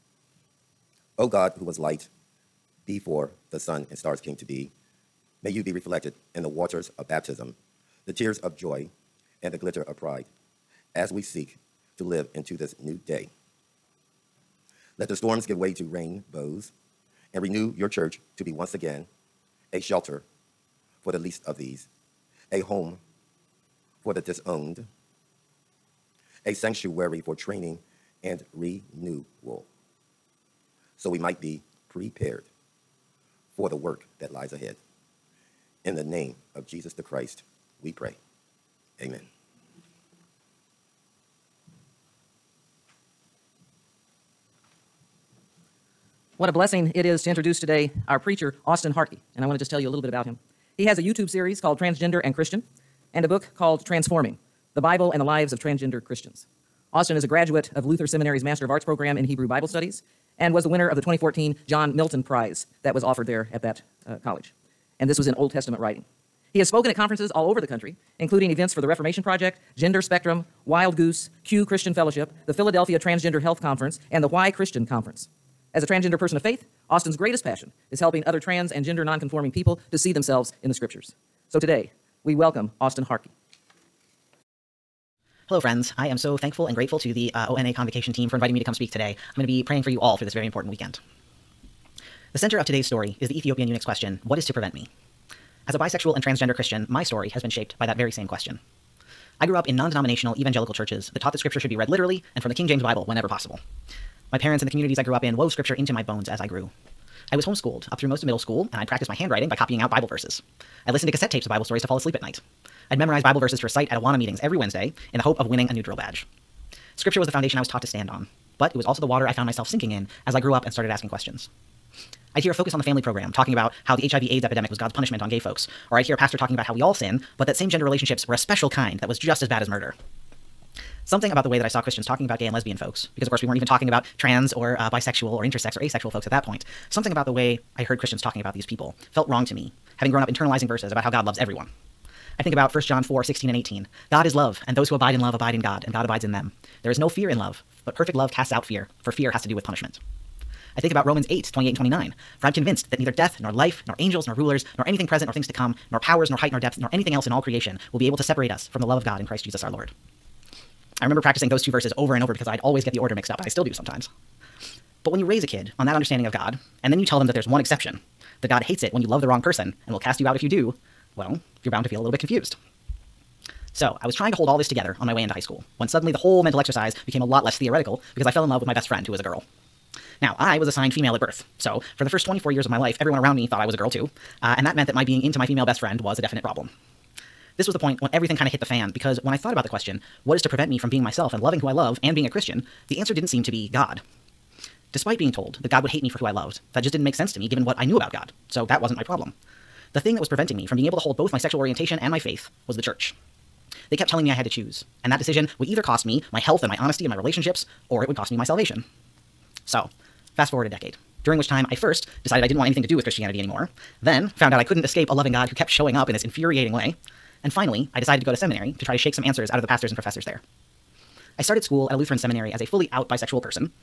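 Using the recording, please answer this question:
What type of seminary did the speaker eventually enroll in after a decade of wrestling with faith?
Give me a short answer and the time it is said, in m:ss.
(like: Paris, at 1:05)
Lutheran, at 3:41.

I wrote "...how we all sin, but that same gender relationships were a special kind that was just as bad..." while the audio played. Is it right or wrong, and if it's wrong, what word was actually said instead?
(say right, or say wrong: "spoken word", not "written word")
right.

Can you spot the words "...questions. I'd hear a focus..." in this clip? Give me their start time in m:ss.
2:01.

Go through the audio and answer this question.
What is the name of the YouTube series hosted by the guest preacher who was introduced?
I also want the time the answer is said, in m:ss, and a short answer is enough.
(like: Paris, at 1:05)
Transgender and Christian, at 0:51.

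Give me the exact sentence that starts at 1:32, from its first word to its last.
The center of today's story is the Ethiopian eunuch's question What is to prevent me?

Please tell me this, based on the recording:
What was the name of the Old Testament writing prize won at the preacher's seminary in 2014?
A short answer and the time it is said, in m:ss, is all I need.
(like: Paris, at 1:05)
John Milton Prize, at 1:01.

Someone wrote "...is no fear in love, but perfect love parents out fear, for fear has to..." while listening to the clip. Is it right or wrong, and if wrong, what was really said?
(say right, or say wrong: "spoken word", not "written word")
wrong: "casts", not "parents".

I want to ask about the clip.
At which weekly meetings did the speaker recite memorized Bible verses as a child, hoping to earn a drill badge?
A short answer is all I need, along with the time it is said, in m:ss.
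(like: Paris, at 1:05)
Awana, at 1:53.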